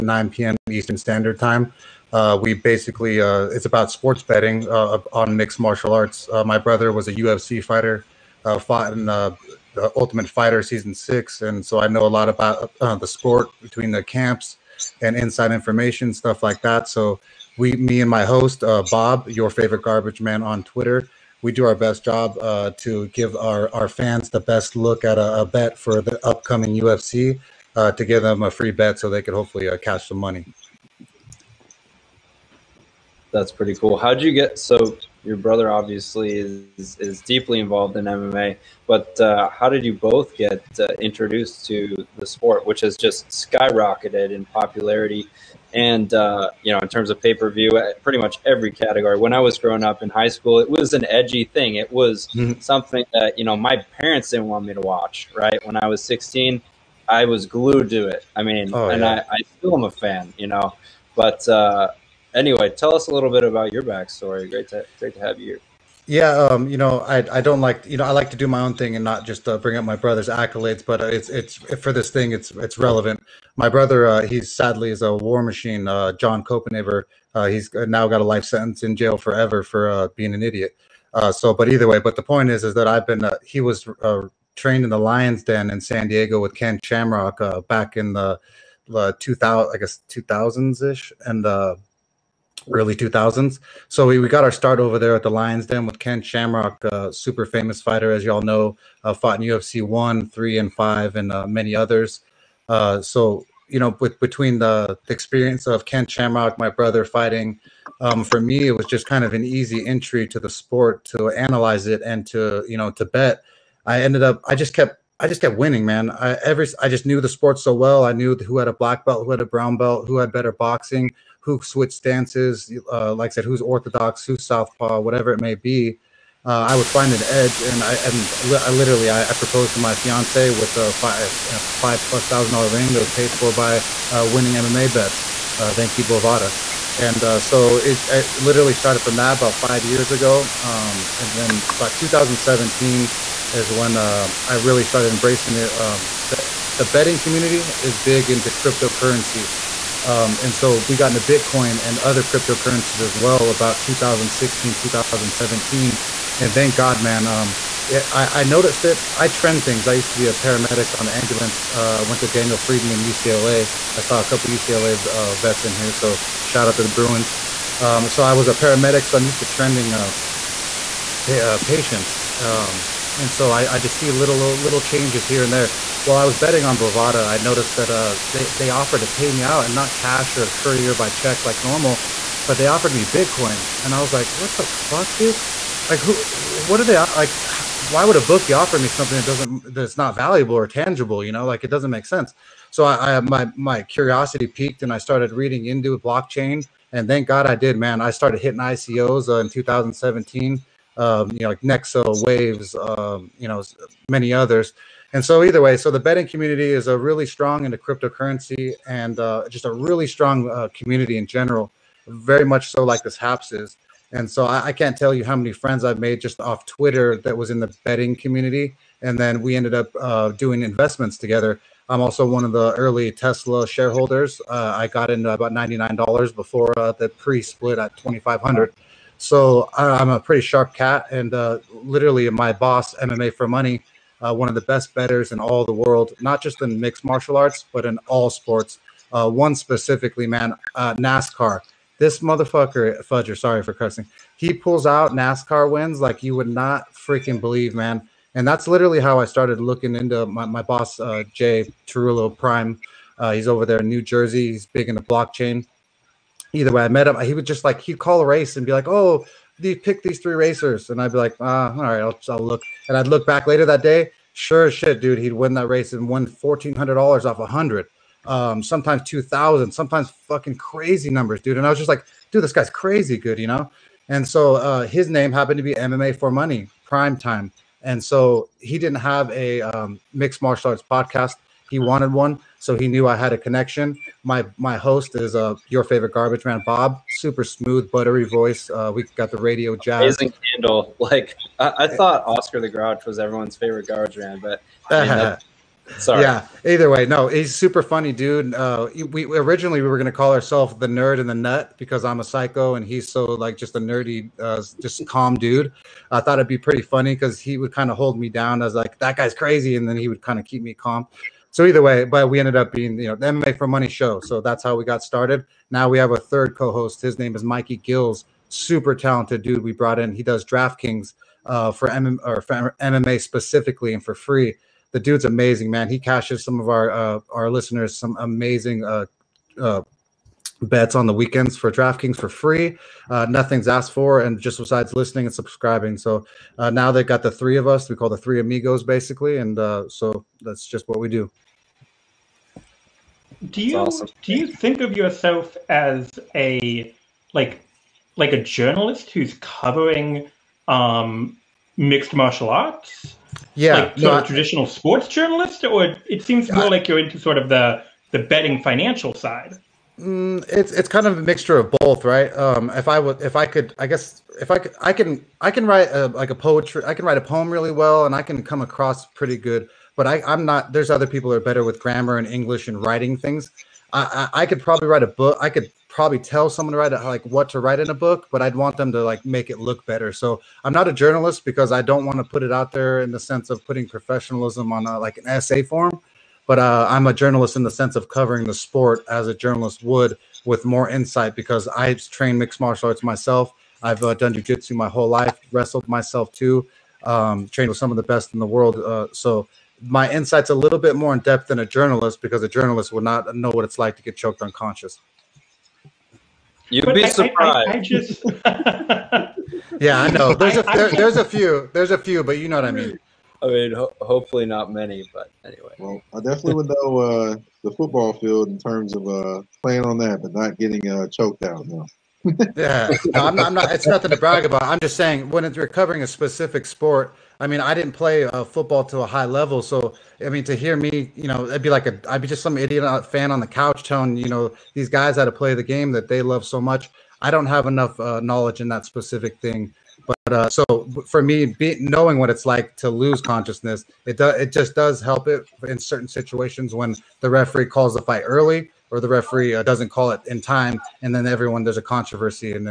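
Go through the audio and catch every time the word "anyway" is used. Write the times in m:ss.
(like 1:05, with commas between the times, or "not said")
1:02, 6:55.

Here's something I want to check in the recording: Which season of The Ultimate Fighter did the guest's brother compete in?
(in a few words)
Season 6.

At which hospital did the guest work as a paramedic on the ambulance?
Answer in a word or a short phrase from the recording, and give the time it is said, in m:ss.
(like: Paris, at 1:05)
Daniel Freeman, at 2:42.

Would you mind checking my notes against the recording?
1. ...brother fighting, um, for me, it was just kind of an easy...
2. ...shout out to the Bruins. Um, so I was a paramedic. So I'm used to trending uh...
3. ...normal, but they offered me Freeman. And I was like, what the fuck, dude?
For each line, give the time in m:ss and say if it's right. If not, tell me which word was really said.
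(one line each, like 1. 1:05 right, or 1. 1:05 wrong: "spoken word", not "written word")
1. 1:46 right
2. 2:46 right
3. 3:01 wrong: "Bitcoin", not "Freeman".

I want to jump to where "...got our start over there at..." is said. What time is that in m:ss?
1:34.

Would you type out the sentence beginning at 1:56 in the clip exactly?
I every I just knew the sport so well.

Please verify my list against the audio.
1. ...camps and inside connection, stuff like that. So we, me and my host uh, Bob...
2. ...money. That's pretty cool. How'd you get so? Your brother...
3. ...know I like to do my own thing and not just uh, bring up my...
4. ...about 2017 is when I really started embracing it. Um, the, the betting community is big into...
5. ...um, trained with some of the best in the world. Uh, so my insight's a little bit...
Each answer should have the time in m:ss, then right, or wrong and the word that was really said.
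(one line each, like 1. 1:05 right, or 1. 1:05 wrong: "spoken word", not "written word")
1. 0:14 wrong: "information", not "connection"
2. 0:30 right
3. 1:07 right
4. 2:21 right
5. 6:37 right.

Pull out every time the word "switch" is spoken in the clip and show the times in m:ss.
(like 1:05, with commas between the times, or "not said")
2:01.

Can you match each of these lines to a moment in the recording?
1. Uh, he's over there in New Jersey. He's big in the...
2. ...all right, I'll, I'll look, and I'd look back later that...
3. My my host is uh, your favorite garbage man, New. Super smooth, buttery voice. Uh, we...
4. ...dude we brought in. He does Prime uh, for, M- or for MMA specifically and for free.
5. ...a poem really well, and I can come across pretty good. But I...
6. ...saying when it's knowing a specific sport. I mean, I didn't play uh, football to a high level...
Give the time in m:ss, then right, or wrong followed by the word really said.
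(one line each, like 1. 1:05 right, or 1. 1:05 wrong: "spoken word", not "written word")
1. 4:13 right
2. 4:21 right
3. 4:44 wrong: "Bob", not "New"
4. 5:19 wrong: "DraftKings", not "Prime"
5. 6:07 right
6. 7:04 wrong: "recovering", not "knowing".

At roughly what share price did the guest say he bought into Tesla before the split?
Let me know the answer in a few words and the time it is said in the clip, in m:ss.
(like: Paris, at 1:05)
$99, at 3:45.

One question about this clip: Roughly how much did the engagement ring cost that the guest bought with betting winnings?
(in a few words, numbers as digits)
$5,000+.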